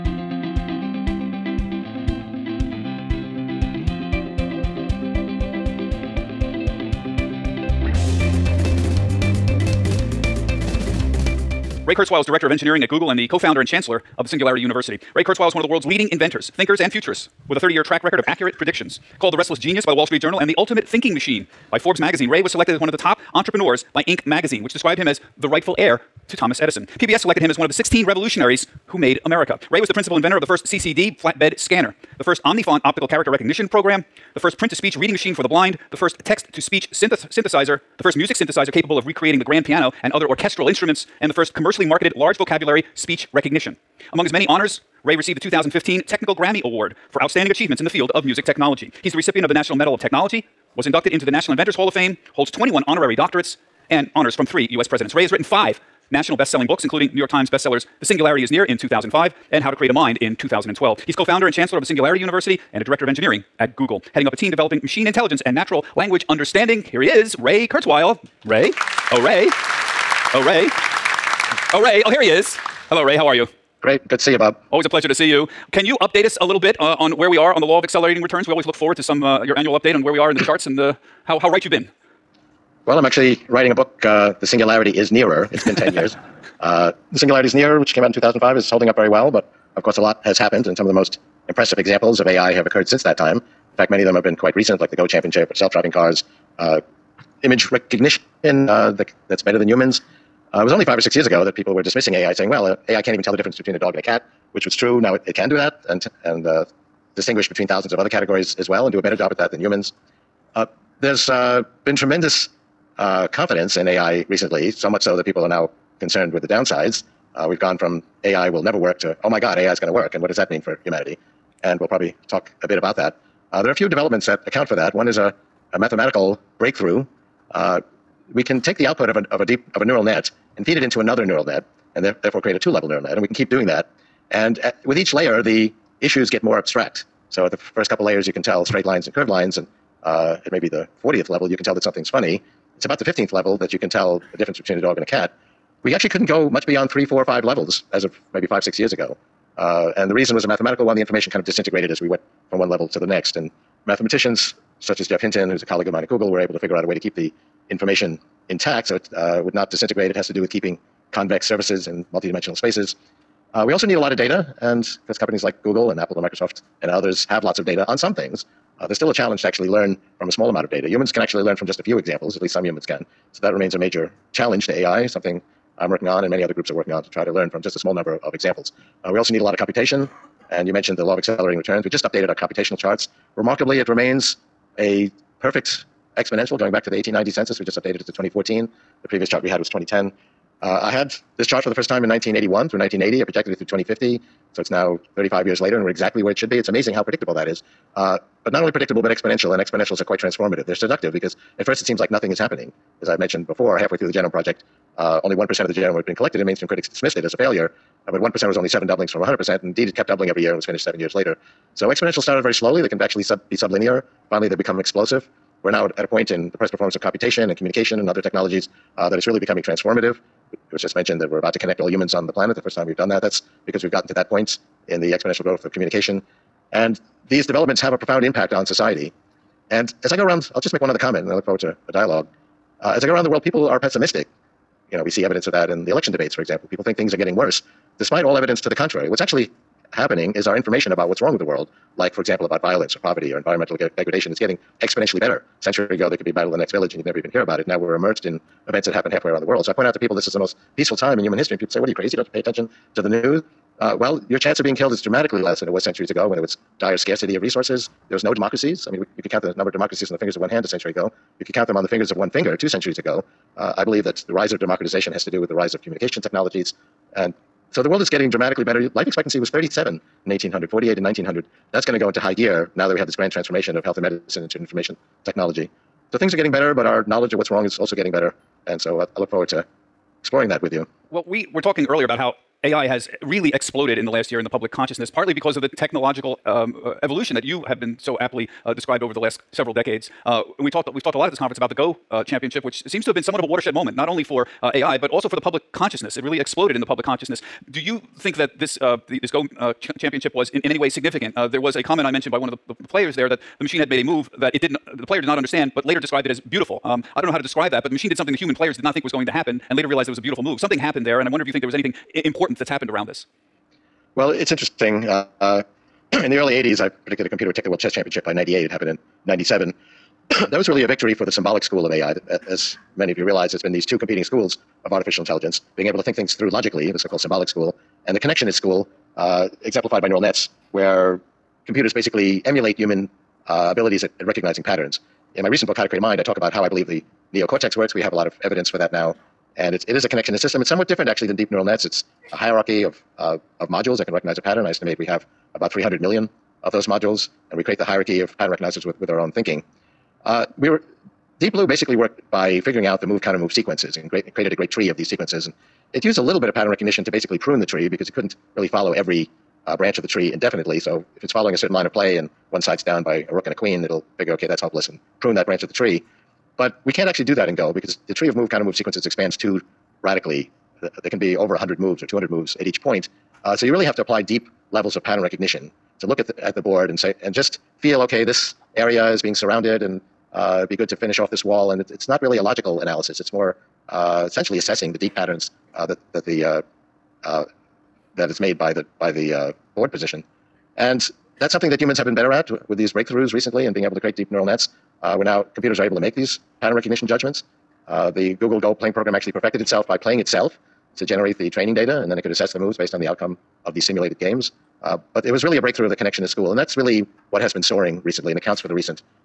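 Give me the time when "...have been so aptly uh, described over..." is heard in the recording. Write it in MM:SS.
04:47.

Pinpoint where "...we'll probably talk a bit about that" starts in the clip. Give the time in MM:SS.
02:01.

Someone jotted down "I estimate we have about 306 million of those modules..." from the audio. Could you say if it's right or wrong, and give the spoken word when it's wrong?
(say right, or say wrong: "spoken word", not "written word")
wrong: "300", not "306".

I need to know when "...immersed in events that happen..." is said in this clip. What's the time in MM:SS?
04:07.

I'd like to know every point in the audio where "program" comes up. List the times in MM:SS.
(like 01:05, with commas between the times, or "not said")
00:33, 06:38.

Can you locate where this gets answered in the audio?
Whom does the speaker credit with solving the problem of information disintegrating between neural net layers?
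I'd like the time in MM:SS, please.
02:35.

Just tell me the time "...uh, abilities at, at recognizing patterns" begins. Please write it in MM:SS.
05:33.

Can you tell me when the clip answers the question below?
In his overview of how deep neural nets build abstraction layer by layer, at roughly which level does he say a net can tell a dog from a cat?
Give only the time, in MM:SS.
02:23.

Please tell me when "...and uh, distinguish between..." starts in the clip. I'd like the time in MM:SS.
01:46.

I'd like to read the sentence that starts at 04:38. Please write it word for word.
And so uh, I look forward to exploring that with you.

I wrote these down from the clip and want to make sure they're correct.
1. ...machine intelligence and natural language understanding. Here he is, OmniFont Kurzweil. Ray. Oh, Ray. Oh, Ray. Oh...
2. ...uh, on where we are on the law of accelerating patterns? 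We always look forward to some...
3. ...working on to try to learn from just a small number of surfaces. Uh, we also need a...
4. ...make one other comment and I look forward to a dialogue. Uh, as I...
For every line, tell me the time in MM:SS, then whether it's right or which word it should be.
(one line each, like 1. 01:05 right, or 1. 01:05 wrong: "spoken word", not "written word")
1. 01:04 wrong: "Ray", not "OmniFont"
2. 01:16 wrong: "returns", not "patterns"
3. 02:56 wrong: "examples", not "surfaces"
4. 03:50 right.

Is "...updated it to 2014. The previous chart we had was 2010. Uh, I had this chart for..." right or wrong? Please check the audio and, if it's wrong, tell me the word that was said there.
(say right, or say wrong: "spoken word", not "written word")
right.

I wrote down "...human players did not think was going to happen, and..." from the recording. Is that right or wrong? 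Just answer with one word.
right.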